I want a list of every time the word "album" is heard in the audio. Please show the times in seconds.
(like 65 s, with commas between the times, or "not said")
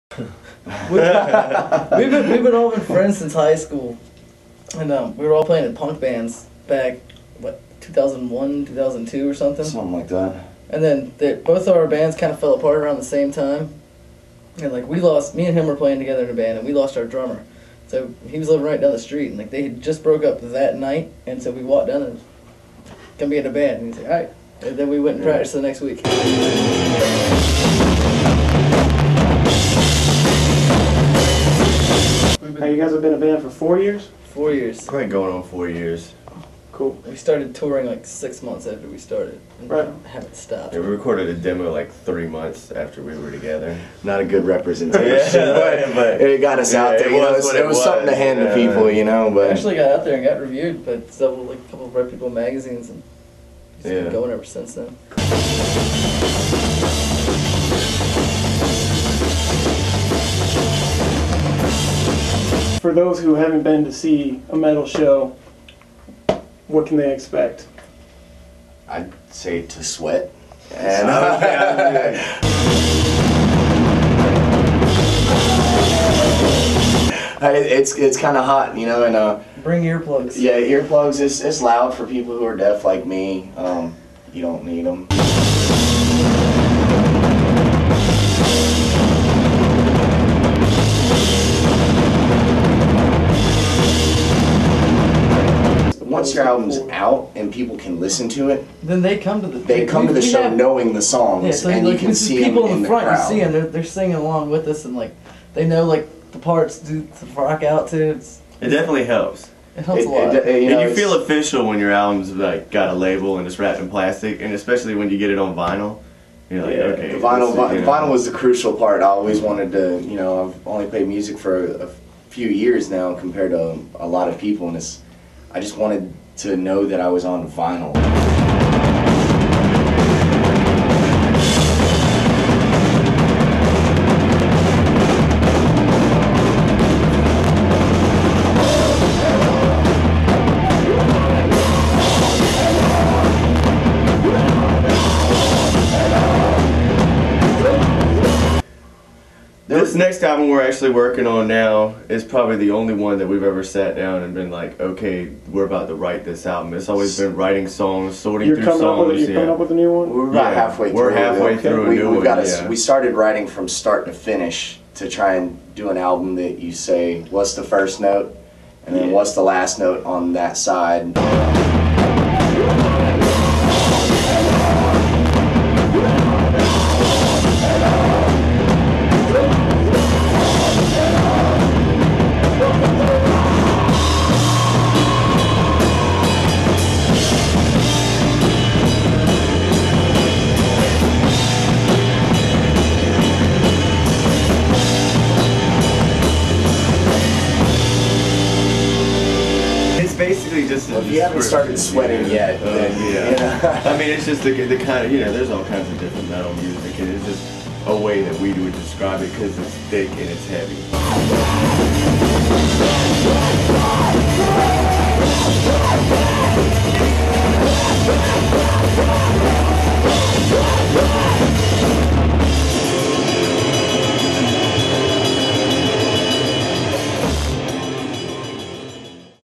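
96 s, 111 s, 150 s, 156 s, 165 s.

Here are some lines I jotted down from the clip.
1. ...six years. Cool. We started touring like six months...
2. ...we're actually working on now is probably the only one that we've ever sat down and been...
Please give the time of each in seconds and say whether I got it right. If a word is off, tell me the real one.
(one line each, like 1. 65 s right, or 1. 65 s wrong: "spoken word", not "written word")
1. 35 s wrong: "four", not "six"
2. 150 s right.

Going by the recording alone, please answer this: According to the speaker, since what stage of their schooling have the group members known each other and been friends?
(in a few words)
high school.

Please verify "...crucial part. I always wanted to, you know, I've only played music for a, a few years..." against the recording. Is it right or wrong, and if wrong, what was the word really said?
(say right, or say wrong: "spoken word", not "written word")
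right.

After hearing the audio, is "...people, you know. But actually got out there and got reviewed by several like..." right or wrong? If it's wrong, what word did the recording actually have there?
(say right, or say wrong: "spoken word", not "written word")
right.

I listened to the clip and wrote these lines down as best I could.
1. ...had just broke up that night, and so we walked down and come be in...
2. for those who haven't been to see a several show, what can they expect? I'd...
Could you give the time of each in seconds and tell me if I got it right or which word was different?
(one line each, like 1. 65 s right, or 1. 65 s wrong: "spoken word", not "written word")
1. 19 s right
2. 62 s wrong: "metal", not "several".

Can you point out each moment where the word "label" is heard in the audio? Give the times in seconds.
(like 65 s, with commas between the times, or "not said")
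112 s.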